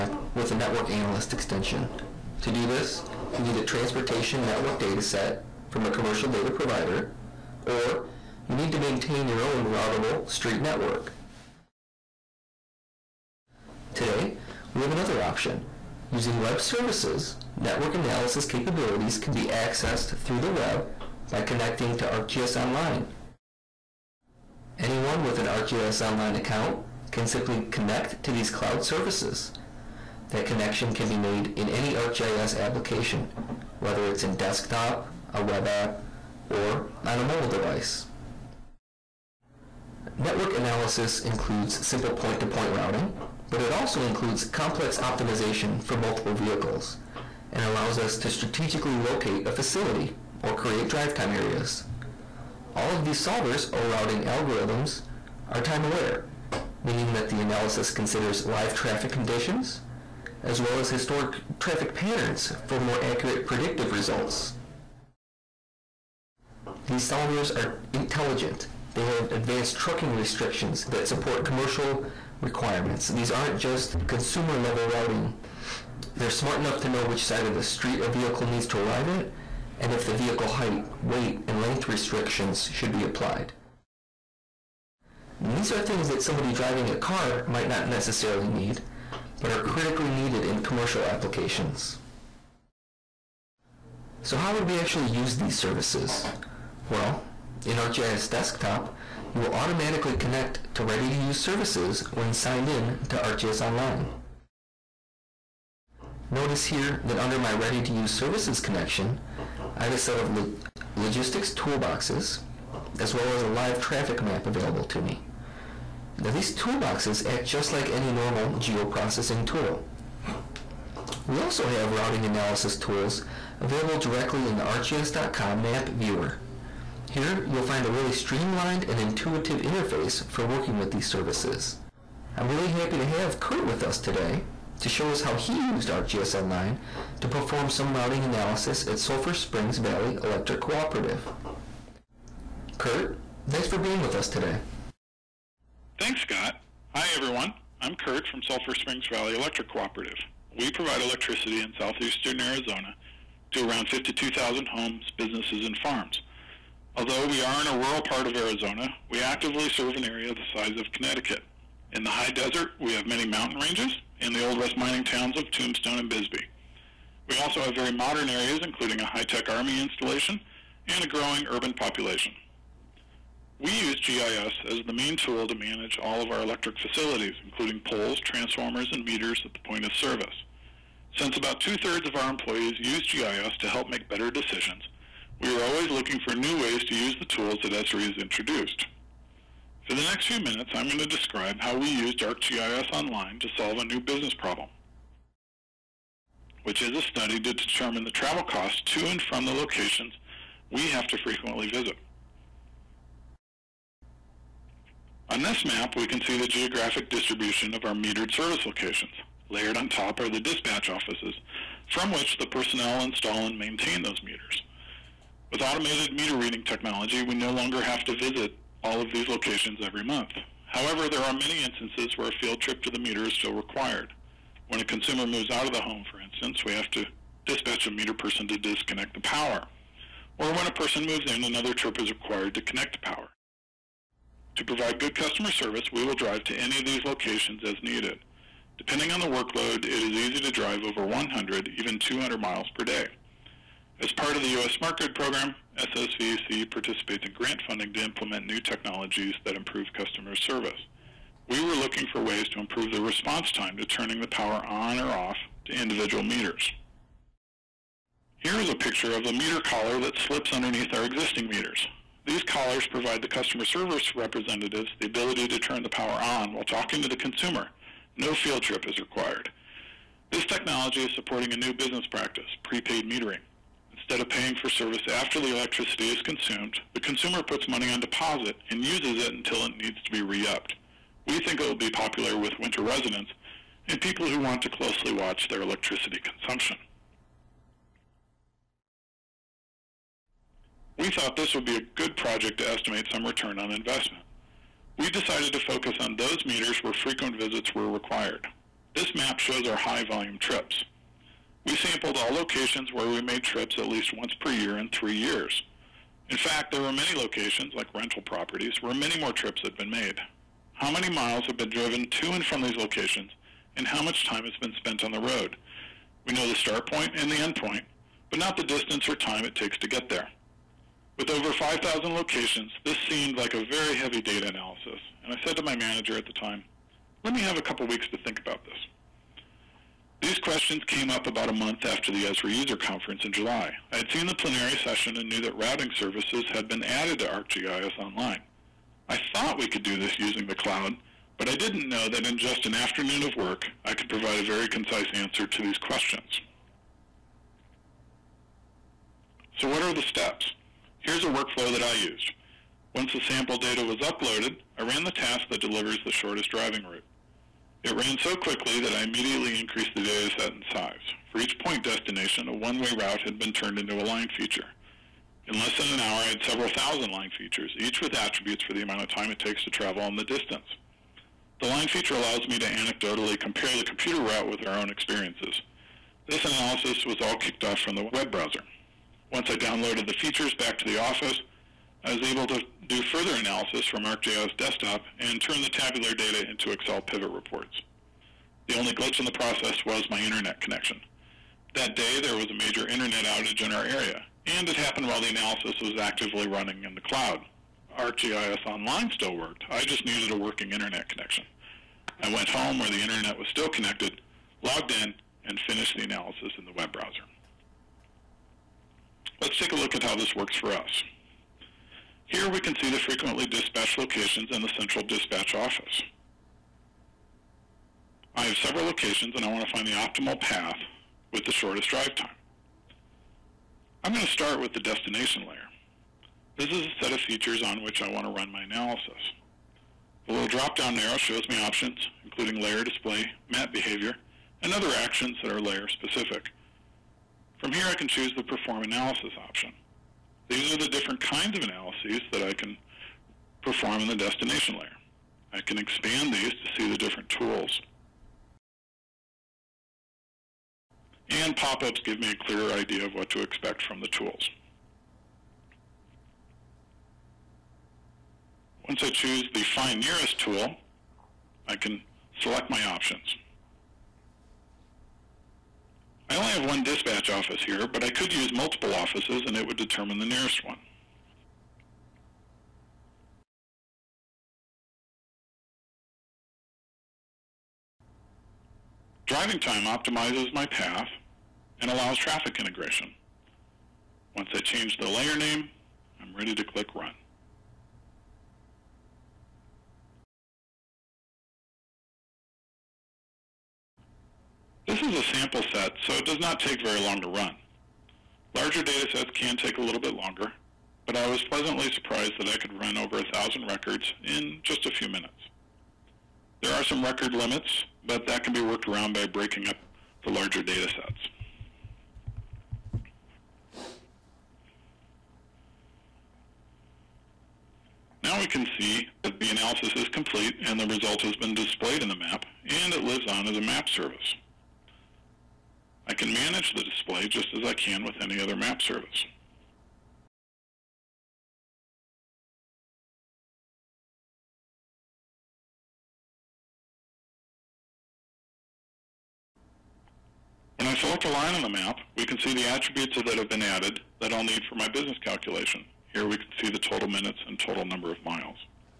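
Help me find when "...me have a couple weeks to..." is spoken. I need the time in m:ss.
5:27.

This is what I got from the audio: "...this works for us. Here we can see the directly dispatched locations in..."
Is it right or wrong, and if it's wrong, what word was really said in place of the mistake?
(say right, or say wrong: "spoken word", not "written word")
wrong: "frequently", not "directly".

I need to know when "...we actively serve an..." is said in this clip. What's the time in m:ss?
2:39.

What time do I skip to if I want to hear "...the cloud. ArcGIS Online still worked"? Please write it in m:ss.
6:36.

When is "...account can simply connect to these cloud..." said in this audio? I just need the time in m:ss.
0:26.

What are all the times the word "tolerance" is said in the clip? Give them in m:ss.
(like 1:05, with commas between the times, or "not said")
not said.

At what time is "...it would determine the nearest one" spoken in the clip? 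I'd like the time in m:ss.
7:49.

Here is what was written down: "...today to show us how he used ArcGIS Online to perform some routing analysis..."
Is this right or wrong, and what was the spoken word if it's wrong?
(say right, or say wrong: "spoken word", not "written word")
right.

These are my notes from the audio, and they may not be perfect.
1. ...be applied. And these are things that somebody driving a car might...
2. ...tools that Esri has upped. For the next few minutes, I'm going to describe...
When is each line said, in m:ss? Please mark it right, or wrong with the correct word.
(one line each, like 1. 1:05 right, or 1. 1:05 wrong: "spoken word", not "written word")
1. 1:22 right
2. 3:07 wrong: "introduced", not "upped".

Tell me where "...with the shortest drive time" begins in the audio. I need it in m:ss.
7:01.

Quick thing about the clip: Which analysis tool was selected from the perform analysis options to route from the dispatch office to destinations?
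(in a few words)
Find Nearest.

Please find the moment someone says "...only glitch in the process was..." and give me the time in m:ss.
6:28.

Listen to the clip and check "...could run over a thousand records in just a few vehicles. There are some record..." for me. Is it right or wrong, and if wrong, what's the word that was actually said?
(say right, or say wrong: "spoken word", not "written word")
wrong: "minutes", not "vehicles".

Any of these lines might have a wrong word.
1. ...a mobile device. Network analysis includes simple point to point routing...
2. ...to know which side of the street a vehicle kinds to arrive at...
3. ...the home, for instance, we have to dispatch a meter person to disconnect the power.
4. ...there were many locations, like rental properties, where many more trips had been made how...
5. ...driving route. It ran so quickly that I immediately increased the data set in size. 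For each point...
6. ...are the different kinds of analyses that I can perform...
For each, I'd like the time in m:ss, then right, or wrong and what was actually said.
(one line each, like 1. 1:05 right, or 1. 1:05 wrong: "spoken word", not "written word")
1. 0:37 right
2. 1:16 wrong: "needs", not "kinds"
3. 3:45 right
4. 5:06 right
5. 5:56 right
6. 7:20 right.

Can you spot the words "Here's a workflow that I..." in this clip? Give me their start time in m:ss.
5:51.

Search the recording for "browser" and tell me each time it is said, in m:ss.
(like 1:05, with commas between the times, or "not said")
6:18, 6:46.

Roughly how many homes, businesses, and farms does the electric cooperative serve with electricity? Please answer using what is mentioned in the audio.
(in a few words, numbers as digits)
52,000.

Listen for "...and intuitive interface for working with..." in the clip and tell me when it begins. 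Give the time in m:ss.
2:08.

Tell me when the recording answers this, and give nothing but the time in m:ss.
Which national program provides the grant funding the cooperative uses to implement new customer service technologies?
4:04.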